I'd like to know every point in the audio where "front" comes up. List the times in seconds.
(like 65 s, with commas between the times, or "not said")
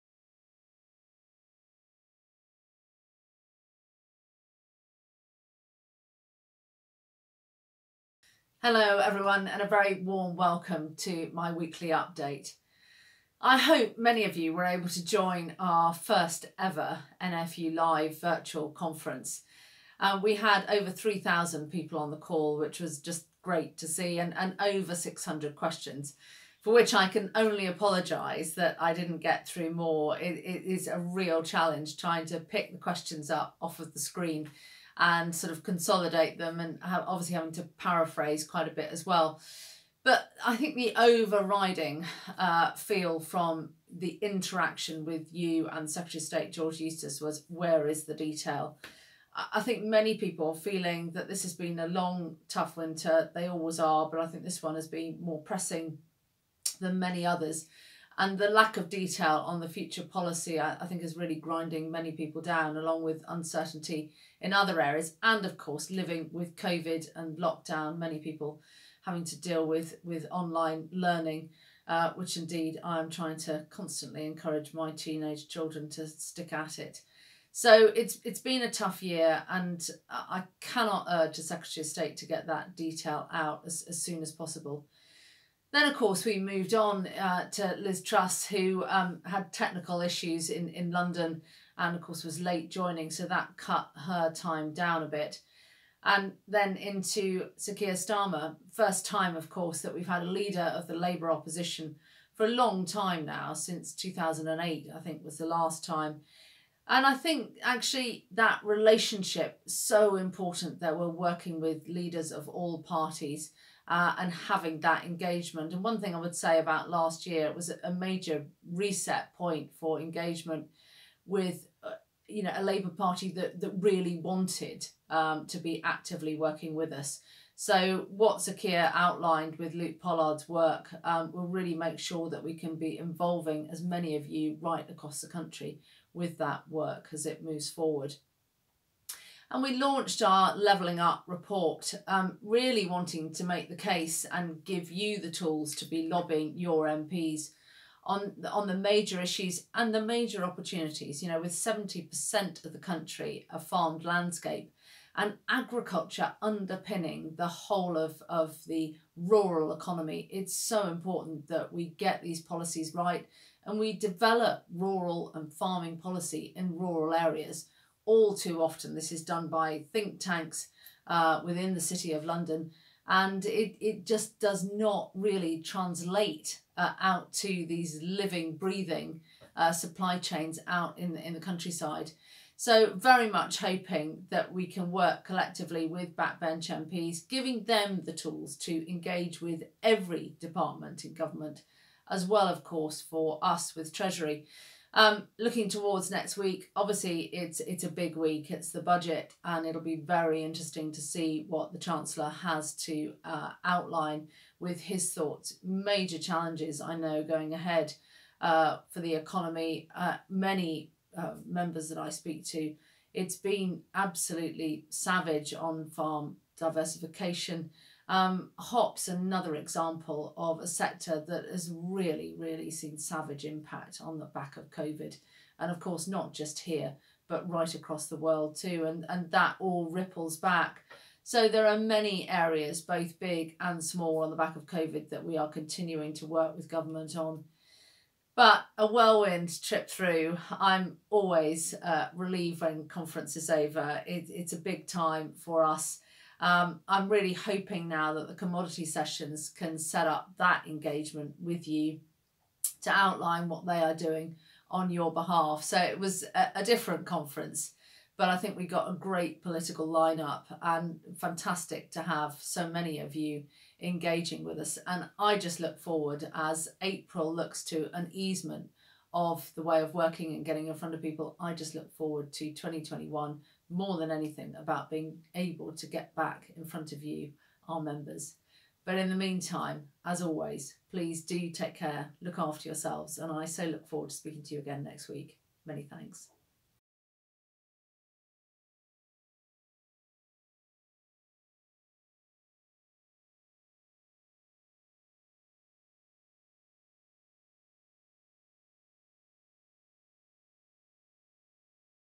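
270 s, 276 s.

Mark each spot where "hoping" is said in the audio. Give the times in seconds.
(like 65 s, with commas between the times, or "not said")
183 s, 247 s.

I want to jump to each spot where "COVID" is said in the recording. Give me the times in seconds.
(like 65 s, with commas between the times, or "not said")
66 s, 224 s, 234 s.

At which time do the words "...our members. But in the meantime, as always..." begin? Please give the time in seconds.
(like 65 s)
277 s.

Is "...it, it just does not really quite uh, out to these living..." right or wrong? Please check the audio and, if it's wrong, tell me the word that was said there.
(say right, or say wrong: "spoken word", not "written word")
wrong: "translate", not "quite".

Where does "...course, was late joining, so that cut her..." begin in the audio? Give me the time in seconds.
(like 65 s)
92 s.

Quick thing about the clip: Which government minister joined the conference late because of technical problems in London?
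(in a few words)
Liz Truss.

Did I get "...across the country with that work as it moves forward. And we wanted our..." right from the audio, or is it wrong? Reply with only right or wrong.
wrong.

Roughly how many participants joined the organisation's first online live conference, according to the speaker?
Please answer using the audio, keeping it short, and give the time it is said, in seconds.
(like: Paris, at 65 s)
over 3,000, at 20 s.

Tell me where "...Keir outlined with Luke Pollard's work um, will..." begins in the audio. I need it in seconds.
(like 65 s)
128 s.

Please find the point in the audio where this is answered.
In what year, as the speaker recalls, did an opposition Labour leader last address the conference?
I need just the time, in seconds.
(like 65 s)
103 s.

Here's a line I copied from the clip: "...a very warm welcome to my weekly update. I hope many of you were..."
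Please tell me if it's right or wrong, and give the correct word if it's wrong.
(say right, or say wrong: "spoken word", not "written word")
right.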